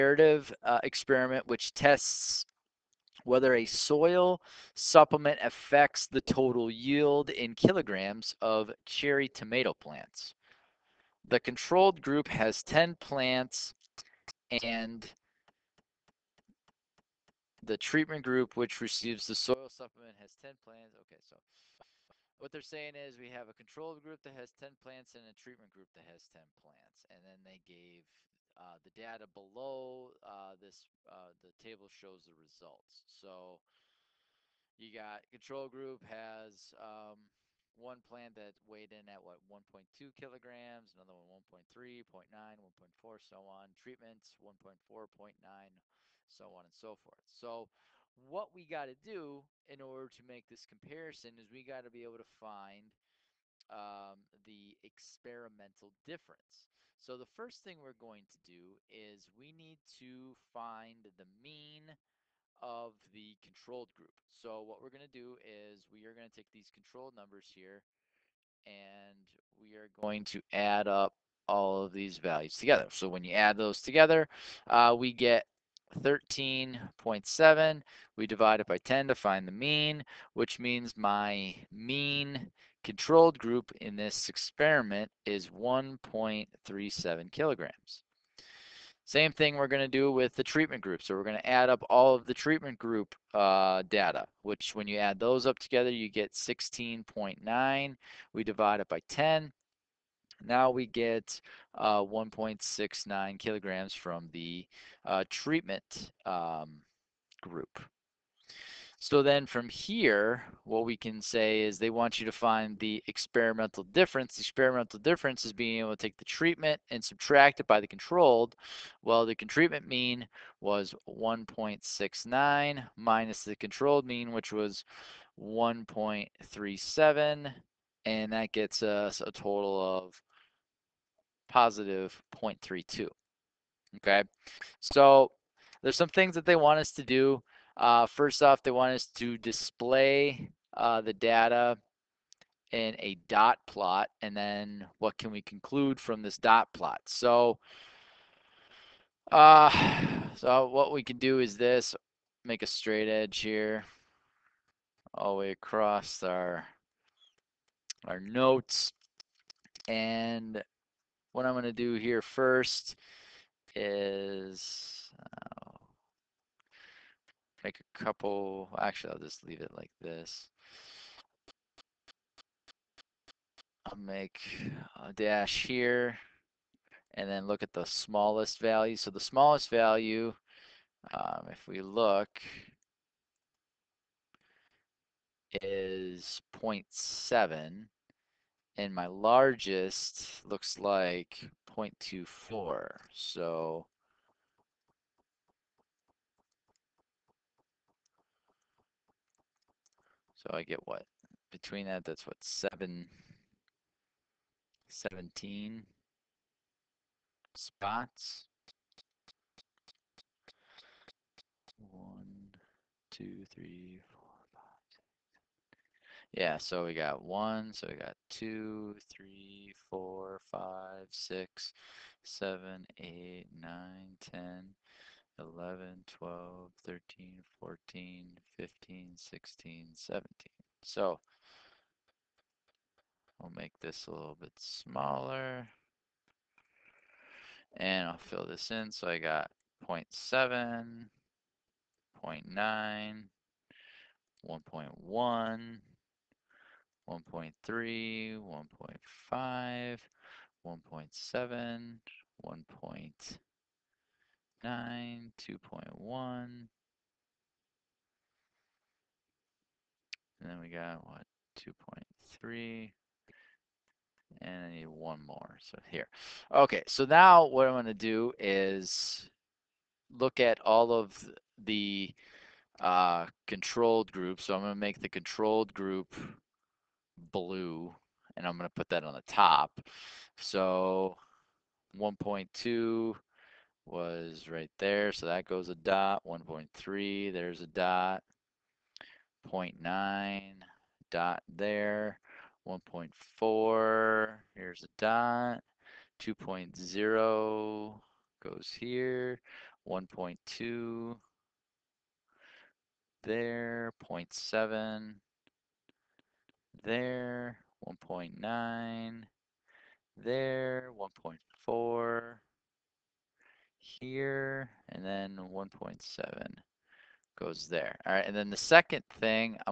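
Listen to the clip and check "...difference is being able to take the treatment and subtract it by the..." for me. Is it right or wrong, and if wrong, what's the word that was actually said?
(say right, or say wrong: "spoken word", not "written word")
right.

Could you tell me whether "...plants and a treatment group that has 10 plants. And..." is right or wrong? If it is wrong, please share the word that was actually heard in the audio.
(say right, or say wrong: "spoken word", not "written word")
right.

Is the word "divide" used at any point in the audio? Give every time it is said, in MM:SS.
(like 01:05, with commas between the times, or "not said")
01:18, 01:38.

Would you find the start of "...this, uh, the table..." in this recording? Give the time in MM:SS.
00:30.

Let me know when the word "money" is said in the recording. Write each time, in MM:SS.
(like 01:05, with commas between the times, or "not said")
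not said.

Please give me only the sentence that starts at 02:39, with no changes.
And what I'm gonna do here first is, uh, make a couple, actually I'll just leave it like this.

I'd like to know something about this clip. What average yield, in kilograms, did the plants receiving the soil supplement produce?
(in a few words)
1.69 kilograms.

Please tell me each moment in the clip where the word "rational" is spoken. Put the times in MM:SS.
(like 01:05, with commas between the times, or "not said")
not said.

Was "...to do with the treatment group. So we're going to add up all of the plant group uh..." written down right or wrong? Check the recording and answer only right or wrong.
wrong.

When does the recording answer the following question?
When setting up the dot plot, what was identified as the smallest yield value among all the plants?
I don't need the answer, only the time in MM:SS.
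03:06.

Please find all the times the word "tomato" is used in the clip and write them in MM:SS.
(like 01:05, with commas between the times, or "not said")
00:09.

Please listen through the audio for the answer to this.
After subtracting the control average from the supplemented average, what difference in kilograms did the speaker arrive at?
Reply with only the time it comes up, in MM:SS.
02:11.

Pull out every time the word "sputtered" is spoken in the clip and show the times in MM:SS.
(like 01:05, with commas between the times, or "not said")
not said.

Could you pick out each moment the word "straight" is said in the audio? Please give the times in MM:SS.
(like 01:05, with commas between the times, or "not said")
02:32.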